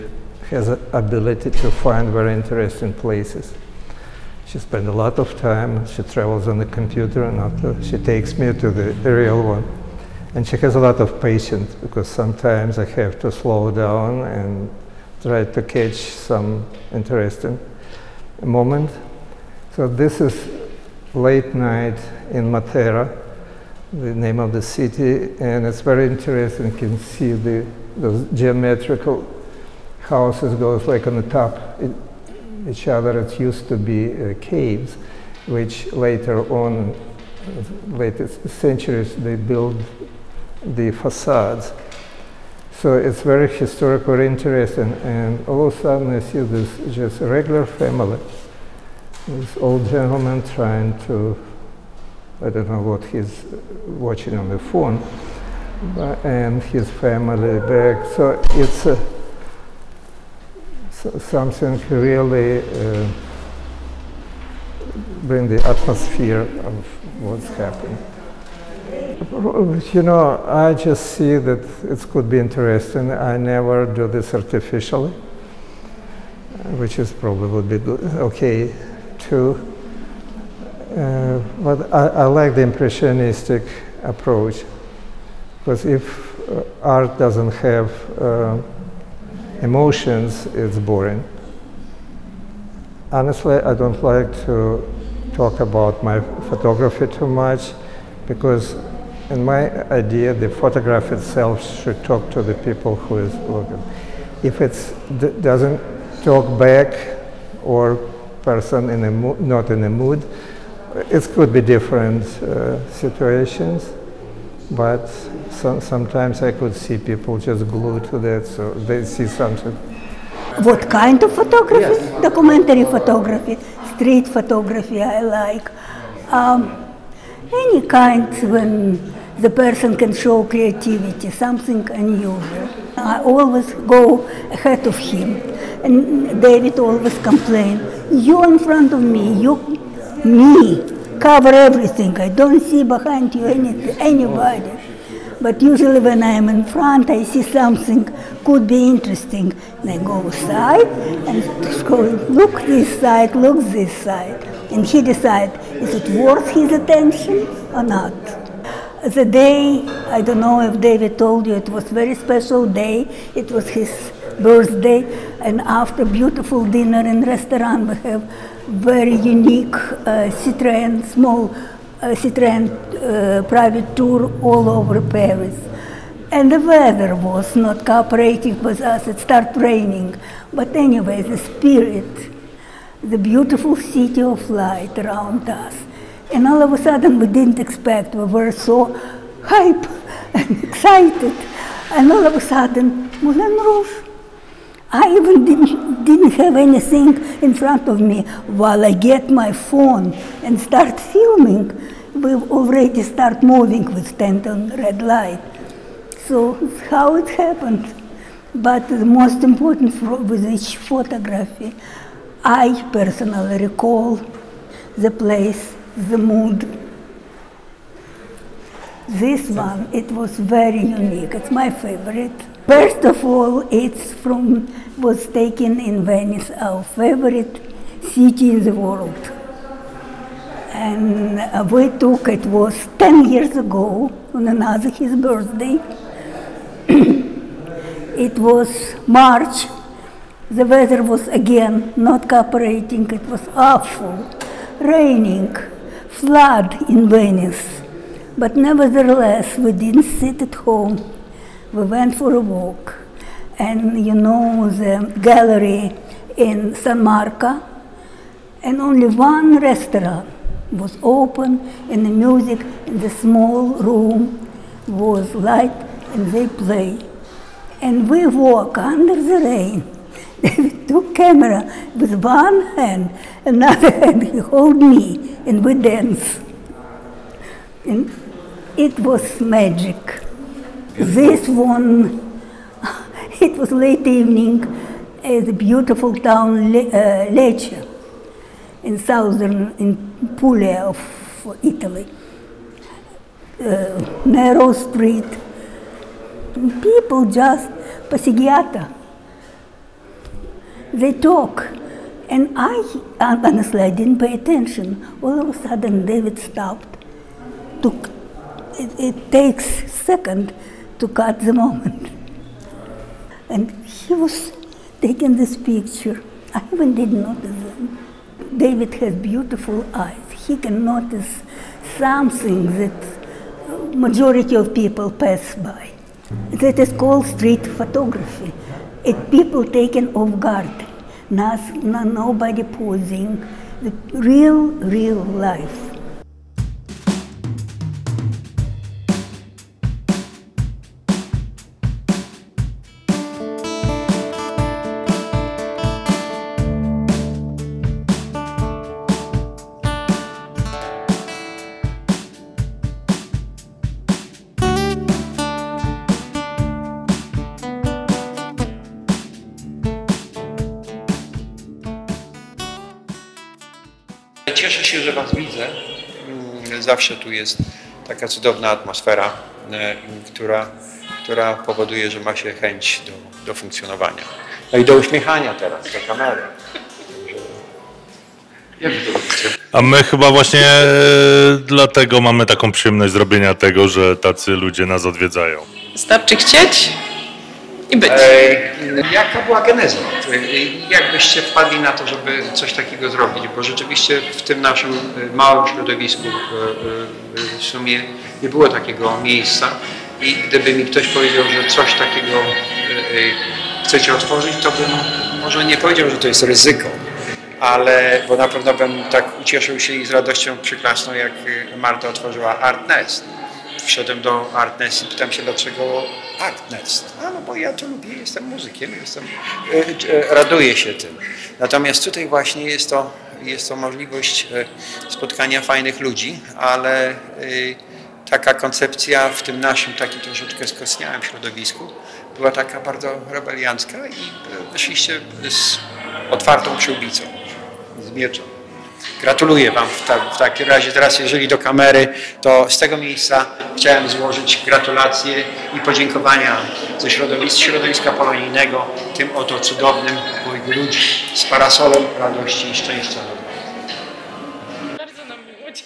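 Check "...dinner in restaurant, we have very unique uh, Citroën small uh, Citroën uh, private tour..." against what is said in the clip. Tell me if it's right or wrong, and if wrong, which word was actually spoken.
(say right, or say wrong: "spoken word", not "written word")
right.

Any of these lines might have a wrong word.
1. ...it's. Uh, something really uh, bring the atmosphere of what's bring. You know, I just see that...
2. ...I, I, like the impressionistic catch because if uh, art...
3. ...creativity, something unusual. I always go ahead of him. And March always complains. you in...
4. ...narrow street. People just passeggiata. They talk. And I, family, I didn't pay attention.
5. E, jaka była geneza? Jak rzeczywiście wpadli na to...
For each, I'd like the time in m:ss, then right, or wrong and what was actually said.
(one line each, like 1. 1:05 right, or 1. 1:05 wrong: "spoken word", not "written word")
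1. 0:58 wrong: "happening", not "bring"
2. 1:21 wrong: "approach", not "catch"
3. 2:10 wrong: "David", not "March"
4. 4:54 wrong: "honestly", not "family"
5. 6:28 wrong: "byście", not "rzeczywiście".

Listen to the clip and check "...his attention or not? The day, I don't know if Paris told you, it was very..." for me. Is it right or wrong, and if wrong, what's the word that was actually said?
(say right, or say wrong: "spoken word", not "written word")
wrong: "David", not "Paris".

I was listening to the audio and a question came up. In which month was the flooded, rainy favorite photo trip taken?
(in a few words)
March.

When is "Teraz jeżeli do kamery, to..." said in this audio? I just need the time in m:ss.
7:20.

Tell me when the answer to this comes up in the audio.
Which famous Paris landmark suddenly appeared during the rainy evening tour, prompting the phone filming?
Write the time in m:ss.
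3:13.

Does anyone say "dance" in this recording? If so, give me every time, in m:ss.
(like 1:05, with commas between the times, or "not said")
4:35.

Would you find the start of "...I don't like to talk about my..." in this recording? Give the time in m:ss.
1:33.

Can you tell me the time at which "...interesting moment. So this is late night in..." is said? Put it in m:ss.
0:16.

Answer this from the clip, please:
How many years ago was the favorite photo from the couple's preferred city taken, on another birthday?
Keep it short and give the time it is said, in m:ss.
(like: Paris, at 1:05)
10, at 3:52.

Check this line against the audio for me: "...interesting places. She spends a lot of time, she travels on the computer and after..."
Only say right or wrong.
right.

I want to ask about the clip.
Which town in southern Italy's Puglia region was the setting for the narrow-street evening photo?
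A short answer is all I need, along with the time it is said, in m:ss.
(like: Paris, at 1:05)
Lecce, at 4:47.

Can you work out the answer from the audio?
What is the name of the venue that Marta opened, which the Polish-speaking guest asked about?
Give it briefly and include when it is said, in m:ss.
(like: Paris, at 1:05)
Art Nest, at 6:52.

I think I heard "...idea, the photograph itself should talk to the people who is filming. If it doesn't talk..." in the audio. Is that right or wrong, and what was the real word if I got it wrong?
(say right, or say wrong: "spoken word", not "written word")
wrong: "looking", not "filming".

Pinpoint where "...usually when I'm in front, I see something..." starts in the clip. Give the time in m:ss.
2:25.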